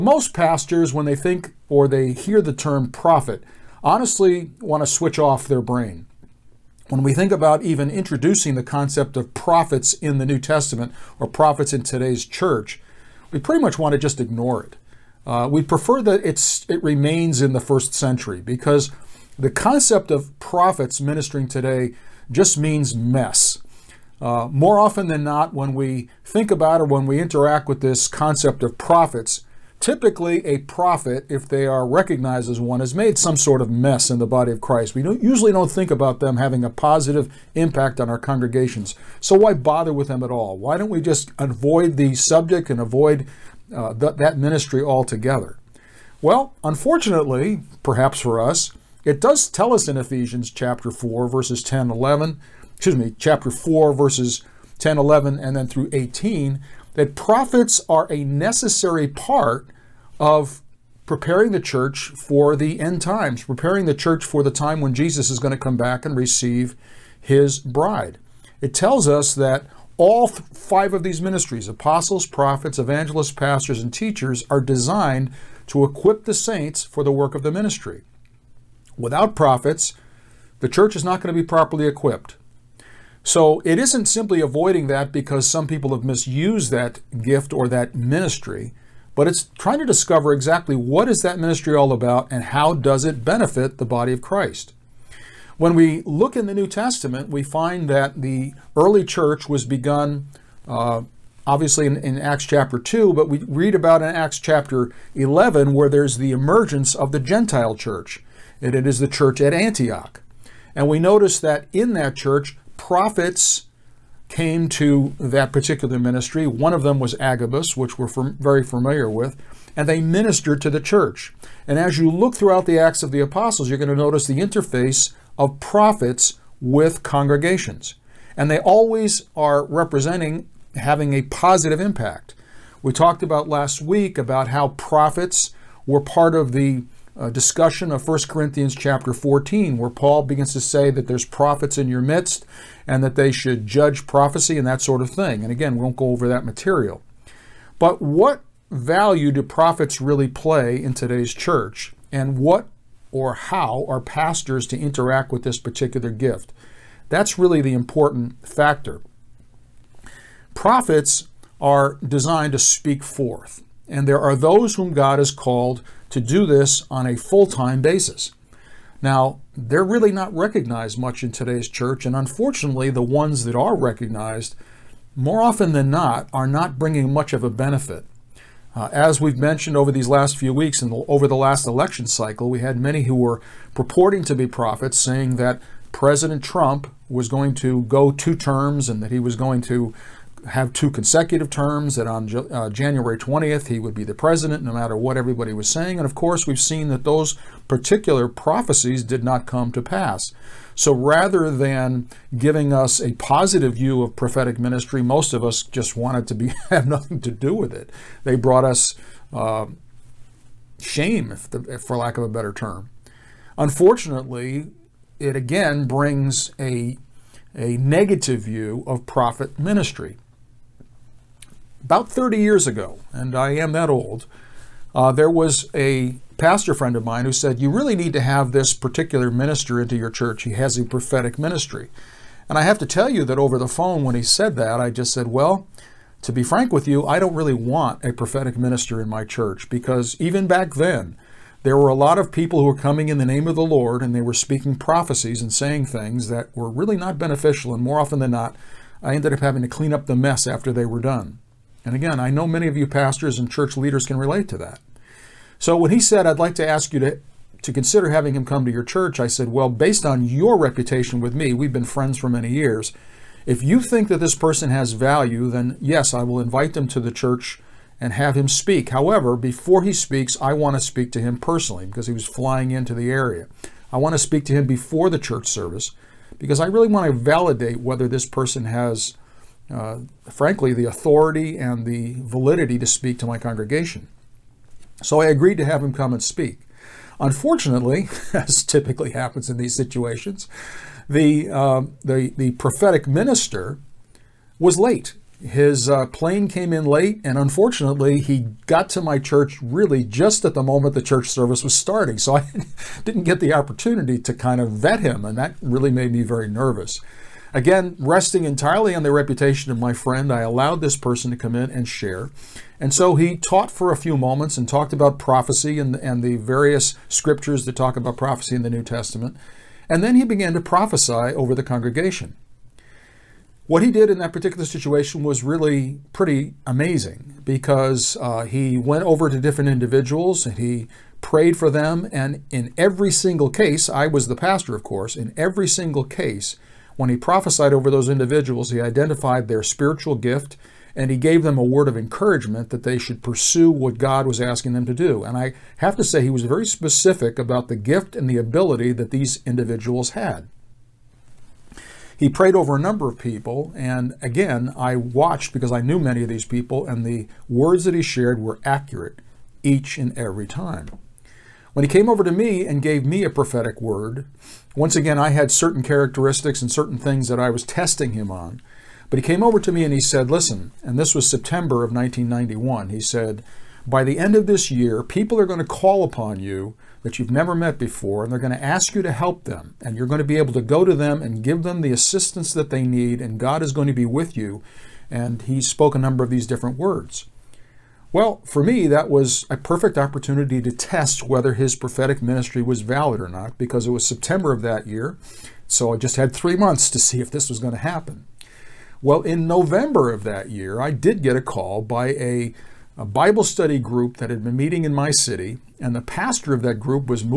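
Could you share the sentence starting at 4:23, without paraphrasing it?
If you think that this person has value, then yes, I will invite them to the church and have him speak.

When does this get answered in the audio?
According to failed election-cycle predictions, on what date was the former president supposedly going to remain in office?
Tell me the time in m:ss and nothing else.
3:12.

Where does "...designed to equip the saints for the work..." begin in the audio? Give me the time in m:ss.
1:14.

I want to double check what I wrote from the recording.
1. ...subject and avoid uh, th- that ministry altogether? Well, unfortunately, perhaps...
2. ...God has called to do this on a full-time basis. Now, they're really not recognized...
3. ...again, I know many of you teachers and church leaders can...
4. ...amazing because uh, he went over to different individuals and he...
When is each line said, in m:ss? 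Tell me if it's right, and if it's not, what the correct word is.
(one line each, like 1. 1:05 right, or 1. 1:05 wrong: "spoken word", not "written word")
1. 0:42 right
2. 2:44 right
3. 4:11 wrong: "pastors", not "teachers"
4. 5:26 right.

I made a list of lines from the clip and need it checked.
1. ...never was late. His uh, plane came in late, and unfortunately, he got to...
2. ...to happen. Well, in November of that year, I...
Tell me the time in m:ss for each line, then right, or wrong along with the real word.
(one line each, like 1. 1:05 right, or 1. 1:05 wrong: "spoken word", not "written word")
1. 4:53 wrong: "minister", not "never"
2. 6:37 right.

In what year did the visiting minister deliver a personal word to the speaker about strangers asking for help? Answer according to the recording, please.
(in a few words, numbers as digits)
1991.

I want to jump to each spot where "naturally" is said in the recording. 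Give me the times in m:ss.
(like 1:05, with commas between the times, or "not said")
not said.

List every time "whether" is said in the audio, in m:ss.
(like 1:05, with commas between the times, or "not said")
4:37, 6:31.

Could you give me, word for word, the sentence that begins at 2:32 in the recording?
And what or how are pastors to interact with this particular gift?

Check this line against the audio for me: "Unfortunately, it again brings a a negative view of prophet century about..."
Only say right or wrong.
wrong.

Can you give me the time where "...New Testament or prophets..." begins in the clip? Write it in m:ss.
0:10.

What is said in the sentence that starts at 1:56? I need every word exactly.
One of them was Agabus, which we're very familiar with, and they ministered to the church.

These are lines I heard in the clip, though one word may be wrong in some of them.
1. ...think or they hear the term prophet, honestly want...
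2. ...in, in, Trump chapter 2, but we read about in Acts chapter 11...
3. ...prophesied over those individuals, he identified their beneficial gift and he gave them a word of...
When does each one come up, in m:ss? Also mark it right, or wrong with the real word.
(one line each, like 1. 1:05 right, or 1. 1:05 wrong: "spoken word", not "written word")
1. 0:01 right
2. 1:41 wrong: "Acts", not "Trump"
3. 5:37 wrong: "spiritual", not "beneficial".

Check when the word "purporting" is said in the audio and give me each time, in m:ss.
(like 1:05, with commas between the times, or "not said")
3:03.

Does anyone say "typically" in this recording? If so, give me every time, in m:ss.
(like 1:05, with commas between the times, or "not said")
0:29, 4:48.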